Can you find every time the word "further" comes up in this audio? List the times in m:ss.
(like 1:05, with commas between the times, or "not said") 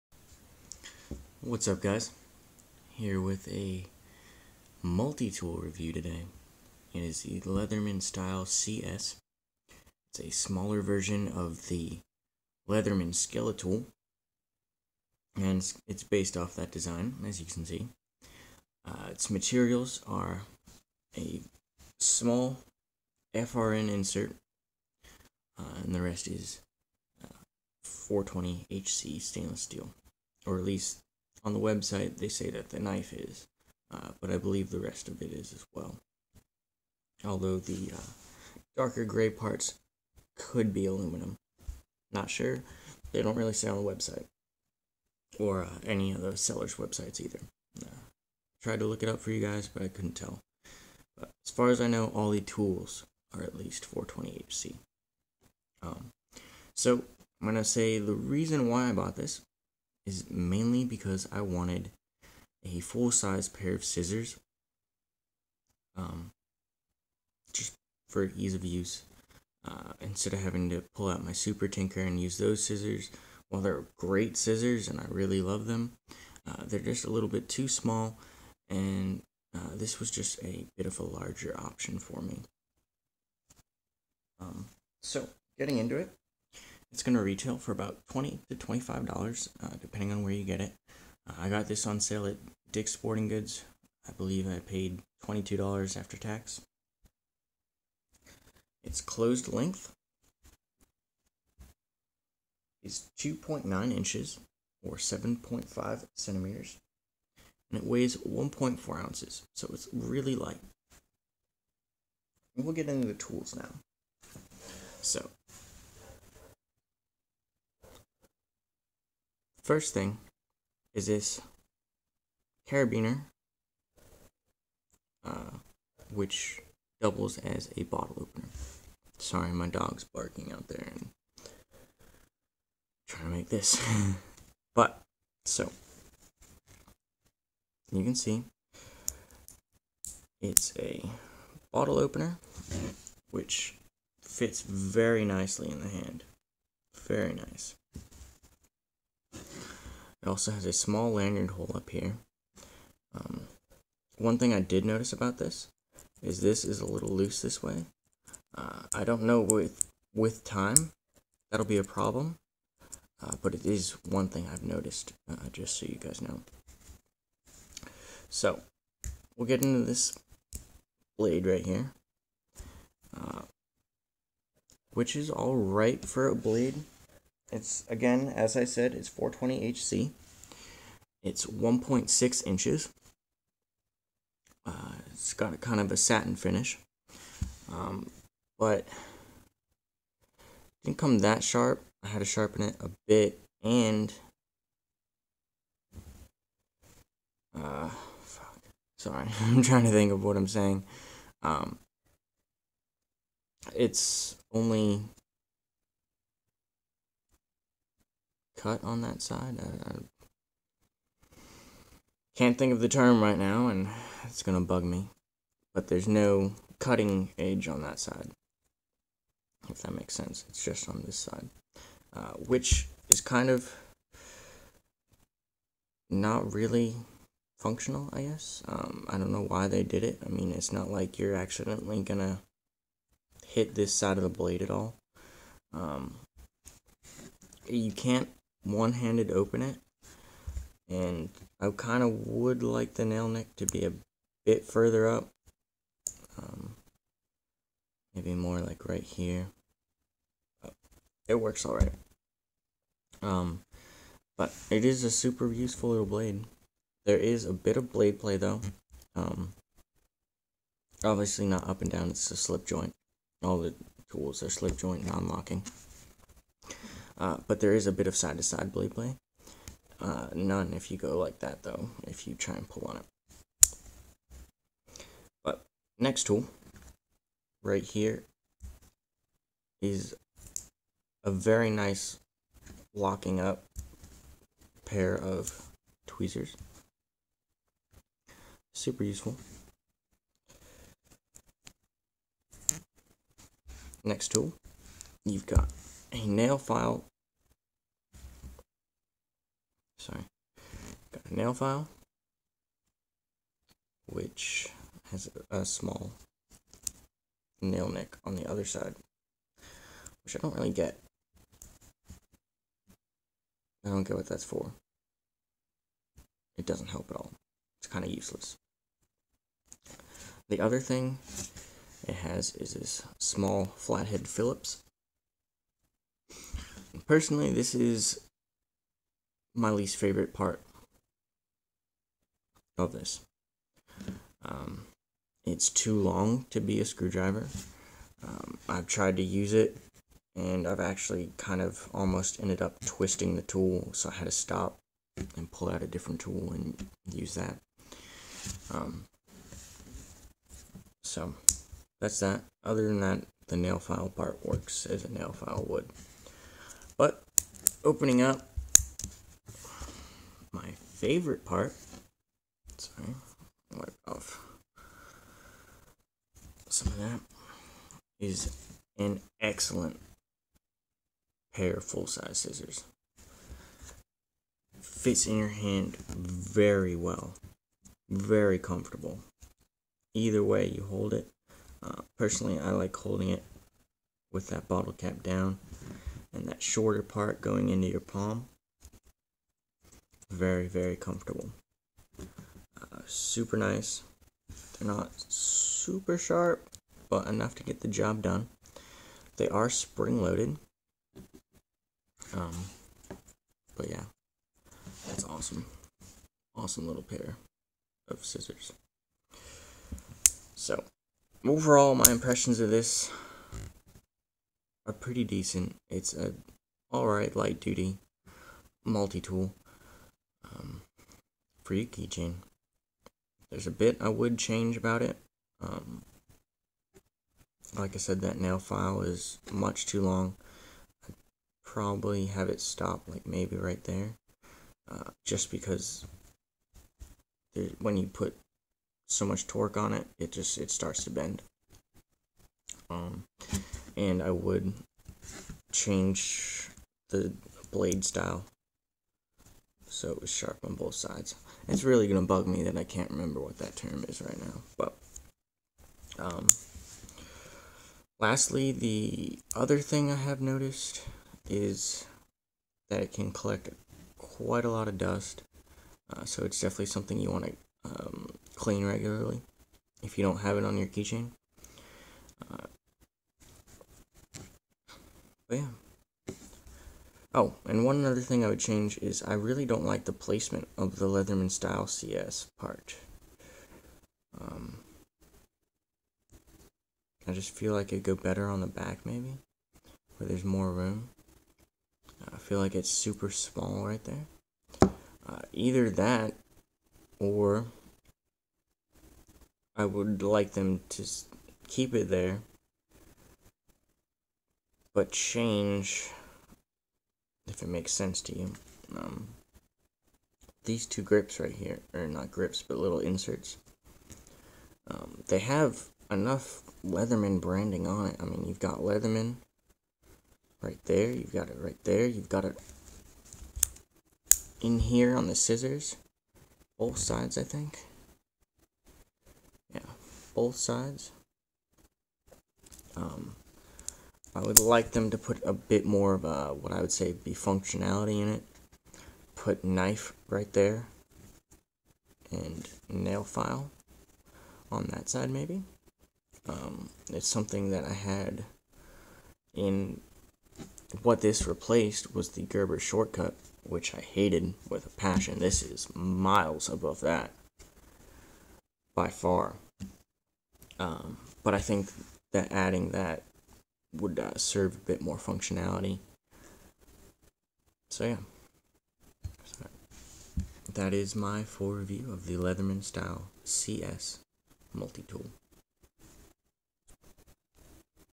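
4:04.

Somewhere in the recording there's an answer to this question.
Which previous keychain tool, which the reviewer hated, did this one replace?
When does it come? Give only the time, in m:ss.
9:12.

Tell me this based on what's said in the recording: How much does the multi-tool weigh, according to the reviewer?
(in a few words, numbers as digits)
1.4 ounces.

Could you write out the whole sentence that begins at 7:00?
Um, for your keychain, there's a bit I would change about it.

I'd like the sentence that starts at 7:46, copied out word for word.
Uh, so it's definitely something you want to um, clean regularly if you don't have it on your keychain.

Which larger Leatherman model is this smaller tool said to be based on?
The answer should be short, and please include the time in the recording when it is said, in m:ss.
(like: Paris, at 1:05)
Skeletool, at 0:13.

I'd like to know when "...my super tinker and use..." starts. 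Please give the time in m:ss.
1:11.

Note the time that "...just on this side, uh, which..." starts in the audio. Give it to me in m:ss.
3:40.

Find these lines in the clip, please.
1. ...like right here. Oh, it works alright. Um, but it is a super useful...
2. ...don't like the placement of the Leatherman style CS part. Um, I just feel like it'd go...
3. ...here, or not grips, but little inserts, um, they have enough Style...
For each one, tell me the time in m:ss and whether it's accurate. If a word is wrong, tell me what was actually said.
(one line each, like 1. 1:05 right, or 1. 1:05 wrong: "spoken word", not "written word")
1. 4:08 right
2. 7:59 right
3. 8:31 wrong: "Leatherman", not "Style".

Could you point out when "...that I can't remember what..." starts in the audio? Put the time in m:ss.
7:32.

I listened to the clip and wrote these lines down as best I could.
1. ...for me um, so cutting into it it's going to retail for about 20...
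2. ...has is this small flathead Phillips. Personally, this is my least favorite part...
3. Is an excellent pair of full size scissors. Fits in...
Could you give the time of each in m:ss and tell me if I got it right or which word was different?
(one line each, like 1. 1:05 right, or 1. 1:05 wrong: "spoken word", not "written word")
1. 1:21 wrong: "getting", not "cutting"
2. 5:22 right
3. 6:08 right.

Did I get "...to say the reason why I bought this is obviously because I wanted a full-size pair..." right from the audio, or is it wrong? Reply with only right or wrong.
wrong.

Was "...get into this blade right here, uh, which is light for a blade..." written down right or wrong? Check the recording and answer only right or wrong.
wrong.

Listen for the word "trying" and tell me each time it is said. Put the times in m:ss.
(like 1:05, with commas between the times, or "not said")
2:13, 3:19.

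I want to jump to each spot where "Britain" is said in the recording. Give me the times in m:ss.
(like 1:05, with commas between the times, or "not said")
not said.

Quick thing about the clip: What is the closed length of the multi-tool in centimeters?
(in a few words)
7.5 centimeters.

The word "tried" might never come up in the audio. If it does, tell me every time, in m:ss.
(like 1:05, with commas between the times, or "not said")
0:48, 5:38.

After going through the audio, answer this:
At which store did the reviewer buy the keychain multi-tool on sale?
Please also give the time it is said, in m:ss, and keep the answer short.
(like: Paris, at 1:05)
Dick's Sporting Goods, at 1:32.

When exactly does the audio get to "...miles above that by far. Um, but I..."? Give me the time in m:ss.
9:15.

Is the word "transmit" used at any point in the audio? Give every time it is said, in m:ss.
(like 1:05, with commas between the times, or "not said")
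not said.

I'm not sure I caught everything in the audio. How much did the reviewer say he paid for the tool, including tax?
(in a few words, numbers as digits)
$22.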